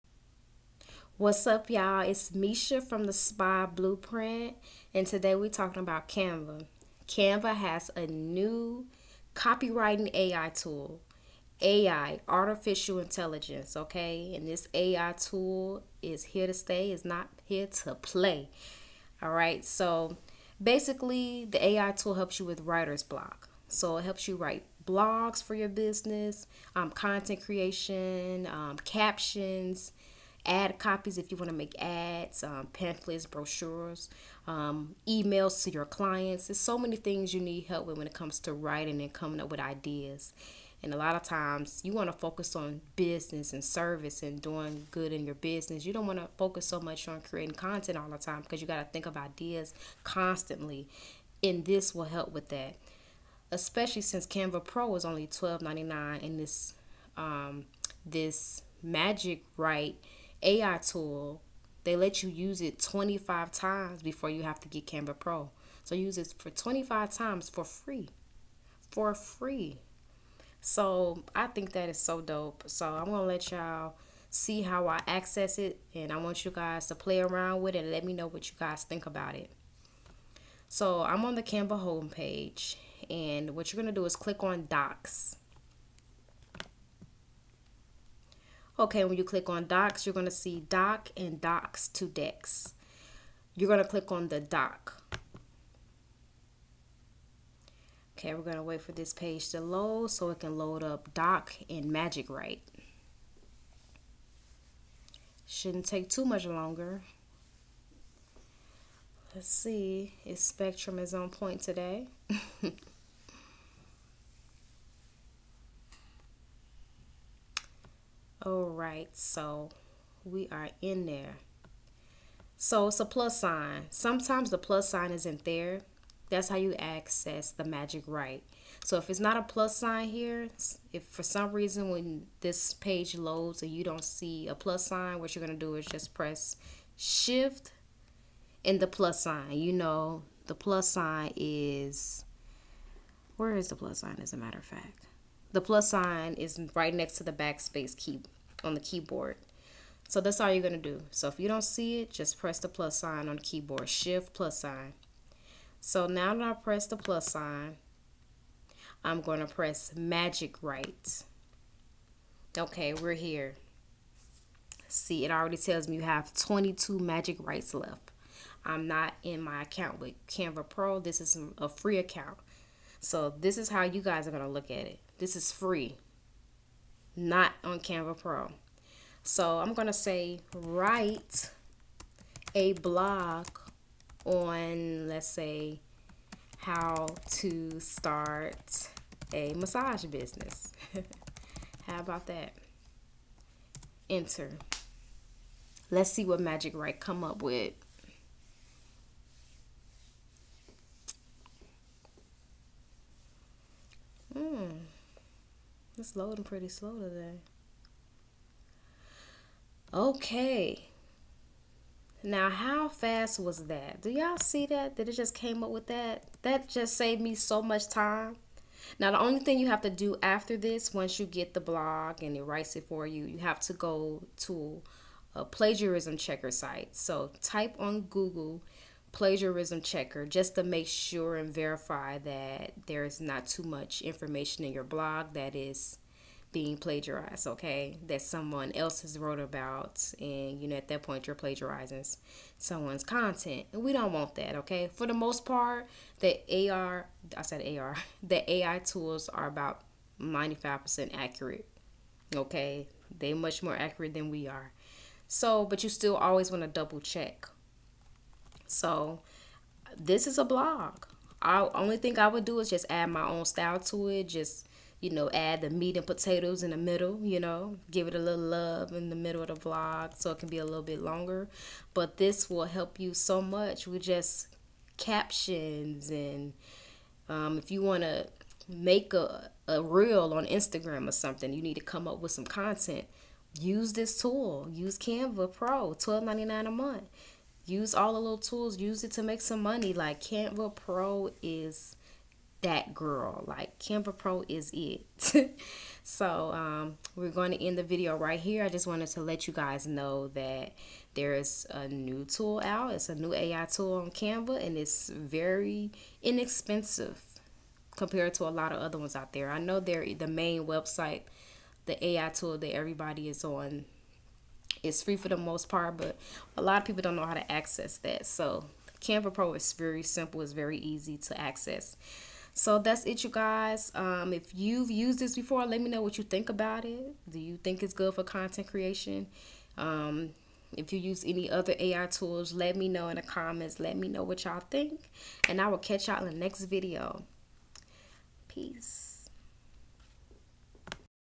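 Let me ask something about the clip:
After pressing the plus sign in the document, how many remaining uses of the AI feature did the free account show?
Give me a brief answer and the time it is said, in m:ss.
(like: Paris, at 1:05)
22, at 2:46.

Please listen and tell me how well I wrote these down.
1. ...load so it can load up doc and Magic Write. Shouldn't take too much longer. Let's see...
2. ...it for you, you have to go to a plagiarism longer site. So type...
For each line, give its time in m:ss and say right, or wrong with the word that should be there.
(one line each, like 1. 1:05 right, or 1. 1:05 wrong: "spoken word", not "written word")
1. 1:39 right
2. 3:42 wrong: "checker", not "longer".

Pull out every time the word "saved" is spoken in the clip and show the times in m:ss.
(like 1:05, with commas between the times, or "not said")
3:36.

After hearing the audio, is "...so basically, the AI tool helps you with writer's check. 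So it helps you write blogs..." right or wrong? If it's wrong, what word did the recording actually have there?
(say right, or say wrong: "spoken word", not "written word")
wrong: "block", not "check".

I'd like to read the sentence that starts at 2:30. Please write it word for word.
So that's all you're going to do.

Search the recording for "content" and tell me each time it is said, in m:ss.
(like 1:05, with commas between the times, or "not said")
0:26, 0:47, 4:03, 4:42, 5:28.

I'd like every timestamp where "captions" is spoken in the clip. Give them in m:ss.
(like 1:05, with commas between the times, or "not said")
0:28, 4:34.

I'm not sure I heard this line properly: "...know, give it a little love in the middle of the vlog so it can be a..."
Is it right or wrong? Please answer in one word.
right.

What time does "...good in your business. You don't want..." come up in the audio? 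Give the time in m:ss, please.
0:44.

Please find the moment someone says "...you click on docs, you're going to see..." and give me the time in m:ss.
1:29.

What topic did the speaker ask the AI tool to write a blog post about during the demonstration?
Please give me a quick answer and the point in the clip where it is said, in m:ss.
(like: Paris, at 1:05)
how to start a massage business, at 3:06.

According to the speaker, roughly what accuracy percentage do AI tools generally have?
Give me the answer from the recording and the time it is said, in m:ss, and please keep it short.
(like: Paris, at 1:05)
95%, at 4:10.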